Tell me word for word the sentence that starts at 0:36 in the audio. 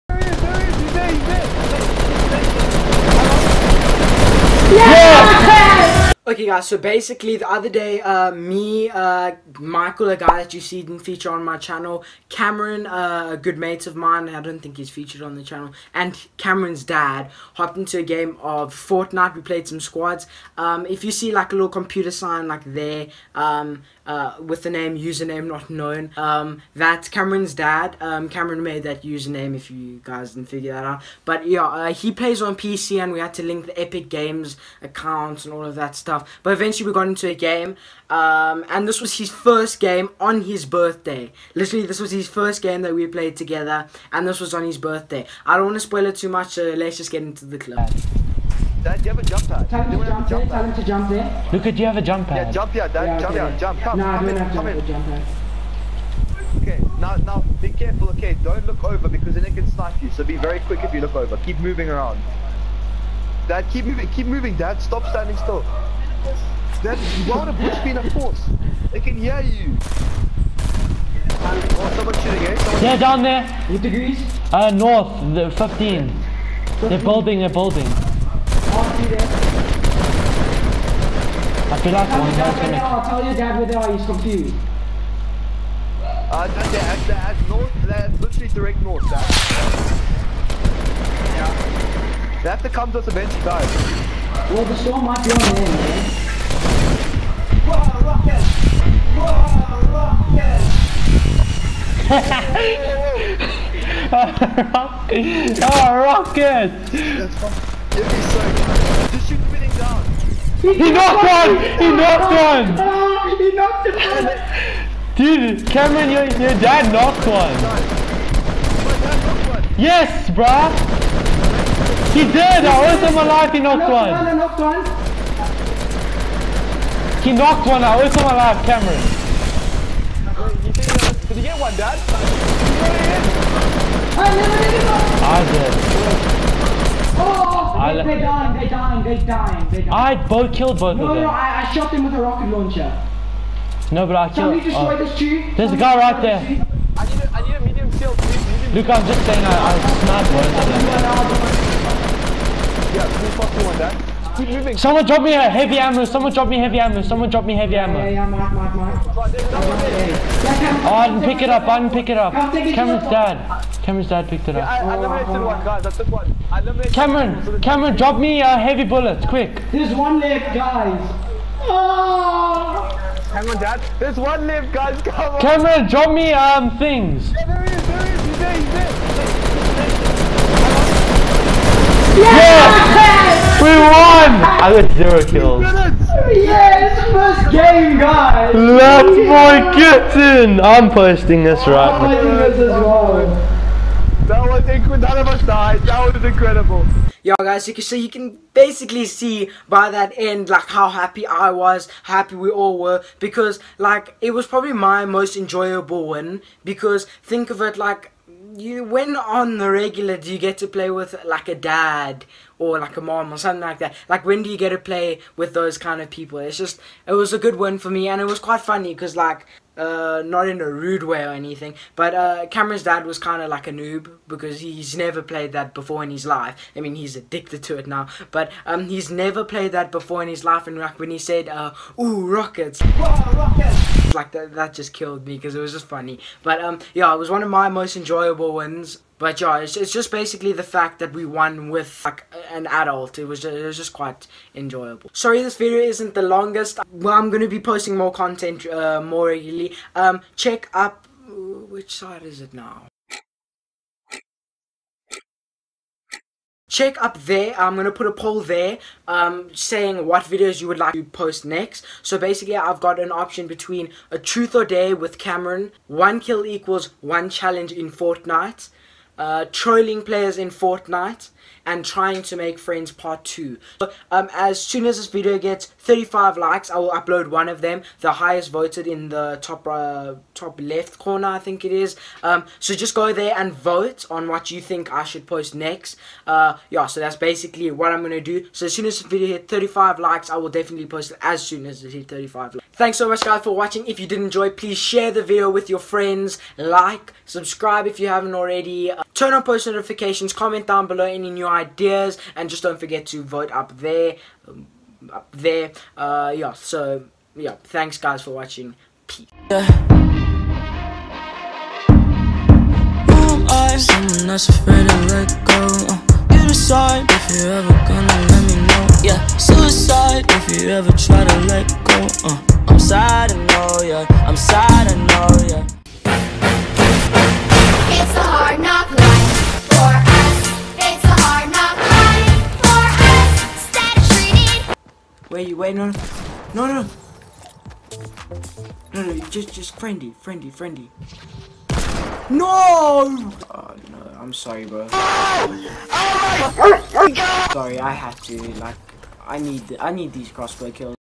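But eventually we got into a game, um, and this was his first game on his birthday.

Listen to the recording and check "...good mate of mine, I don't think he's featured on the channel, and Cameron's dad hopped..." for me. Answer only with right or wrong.
right.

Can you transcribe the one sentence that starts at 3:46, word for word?
I mean, he's addicted to it now, but um, he's never played that before in his life.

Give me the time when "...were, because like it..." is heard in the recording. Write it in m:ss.
3:22.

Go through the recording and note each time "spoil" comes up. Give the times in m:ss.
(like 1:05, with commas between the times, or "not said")
0:45.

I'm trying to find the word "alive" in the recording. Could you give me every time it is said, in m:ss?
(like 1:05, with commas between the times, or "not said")
2:03, 2:08.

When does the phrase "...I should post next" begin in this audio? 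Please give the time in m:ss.
4:44.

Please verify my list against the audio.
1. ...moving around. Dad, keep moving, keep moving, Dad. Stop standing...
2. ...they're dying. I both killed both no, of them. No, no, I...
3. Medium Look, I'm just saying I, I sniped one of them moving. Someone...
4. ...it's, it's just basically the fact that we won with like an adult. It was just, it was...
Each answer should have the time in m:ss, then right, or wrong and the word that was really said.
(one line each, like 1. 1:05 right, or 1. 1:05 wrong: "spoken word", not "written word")
1. 1:01 right
2. 2:19 right
3. 2:28 right
4. 3:59 right.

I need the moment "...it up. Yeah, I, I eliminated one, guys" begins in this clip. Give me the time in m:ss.
2:44.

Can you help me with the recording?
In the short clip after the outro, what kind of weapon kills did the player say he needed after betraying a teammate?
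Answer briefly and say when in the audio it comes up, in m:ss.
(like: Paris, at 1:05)
Crossbow kills, at 5:50.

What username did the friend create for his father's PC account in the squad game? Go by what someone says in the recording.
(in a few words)
username not known.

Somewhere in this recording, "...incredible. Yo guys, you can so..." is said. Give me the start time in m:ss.
3:16.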